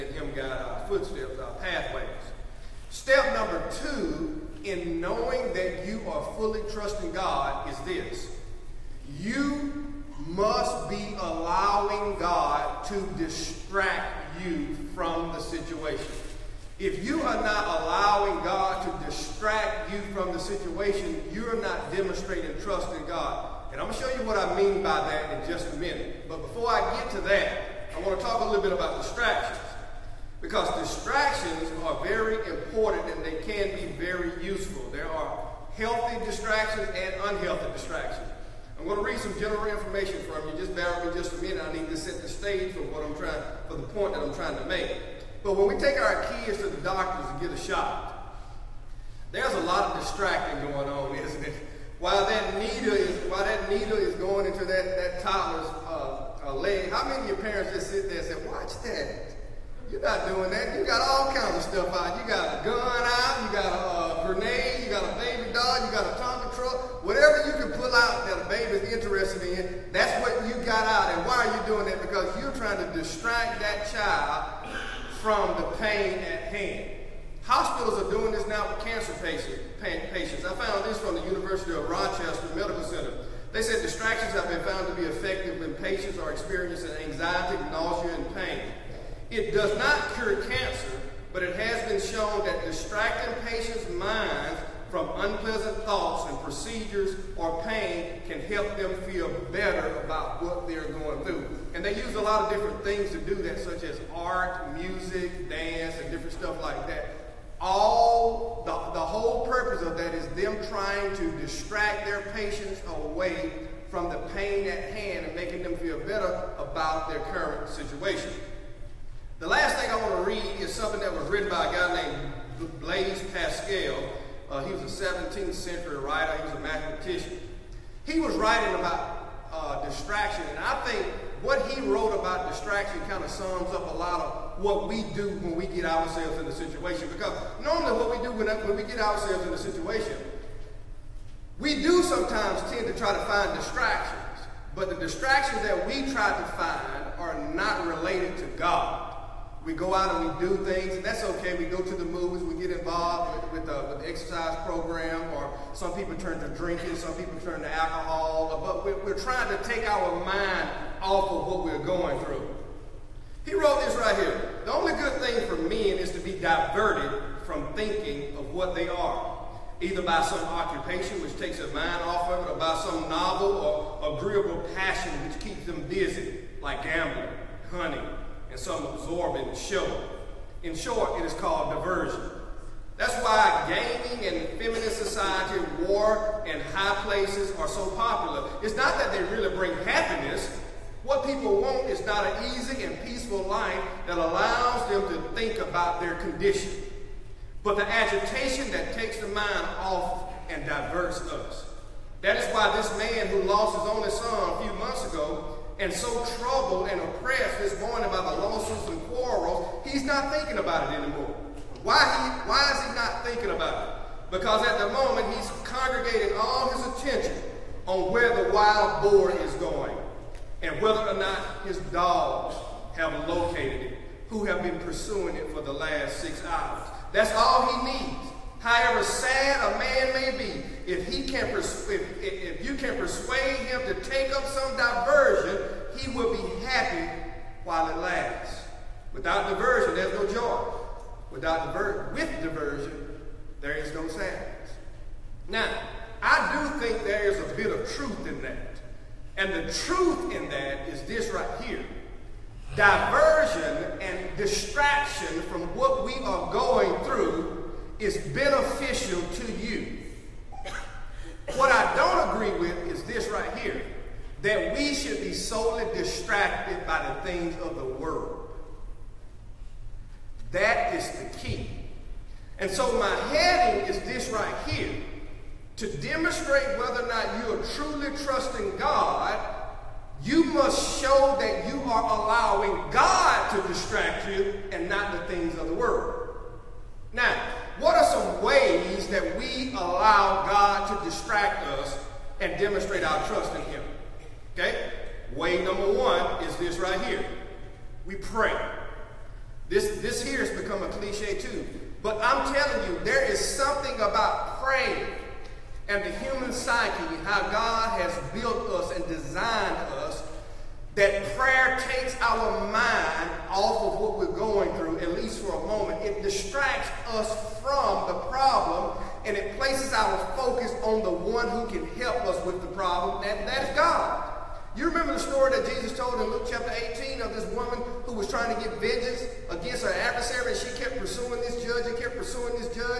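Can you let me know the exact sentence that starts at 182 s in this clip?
That's why gaming and feminist society, war, and high places are so popular.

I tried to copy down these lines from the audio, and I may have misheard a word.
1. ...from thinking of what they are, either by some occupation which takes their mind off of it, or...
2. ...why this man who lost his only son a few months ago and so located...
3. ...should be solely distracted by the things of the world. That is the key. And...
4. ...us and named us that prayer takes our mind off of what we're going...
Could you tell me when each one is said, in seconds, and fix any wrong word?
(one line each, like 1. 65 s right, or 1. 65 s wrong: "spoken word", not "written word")
1. 167 s right
2. 202 s wrong: "troubled", not "located"
3. 264 s right
4. 308 s wrong: "designed", not "named".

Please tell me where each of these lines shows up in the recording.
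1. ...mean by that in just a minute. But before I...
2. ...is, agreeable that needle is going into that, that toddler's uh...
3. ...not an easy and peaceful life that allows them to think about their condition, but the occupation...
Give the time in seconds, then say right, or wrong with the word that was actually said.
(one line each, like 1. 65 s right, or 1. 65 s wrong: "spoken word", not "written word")
1. 24 s right
2. 52 s wrong: "while", not "agreeable"
3. 192 s wrong: "agitation", not "occupation".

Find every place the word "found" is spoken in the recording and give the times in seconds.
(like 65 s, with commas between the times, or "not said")
80 s, 84 s.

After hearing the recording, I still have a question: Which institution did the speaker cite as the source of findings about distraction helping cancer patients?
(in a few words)
University of Rochester Medical Center.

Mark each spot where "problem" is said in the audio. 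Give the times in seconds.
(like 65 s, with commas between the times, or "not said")
318 s, 322 s.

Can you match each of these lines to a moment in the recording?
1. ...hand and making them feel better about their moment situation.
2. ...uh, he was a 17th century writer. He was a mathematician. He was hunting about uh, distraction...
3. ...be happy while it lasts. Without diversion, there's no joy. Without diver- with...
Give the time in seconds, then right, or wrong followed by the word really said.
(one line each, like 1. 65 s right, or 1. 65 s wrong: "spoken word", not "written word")
1. 114 s wrong: "current", not "moment"
2. 124 s wrong: "writing", not "hunting"
3. 236 s right.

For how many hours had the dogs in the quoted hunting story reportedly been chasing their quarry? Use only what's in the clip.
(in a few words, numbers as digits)
6.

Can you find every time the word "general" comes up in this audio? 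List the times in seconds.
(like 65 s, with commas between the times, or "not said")
39 s.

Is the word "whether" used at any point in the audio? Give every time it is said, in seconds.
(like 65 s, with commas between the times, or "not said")
220 s, 276 s.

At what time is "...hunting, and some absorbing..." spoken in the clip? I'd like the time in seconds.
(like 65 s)
177 s.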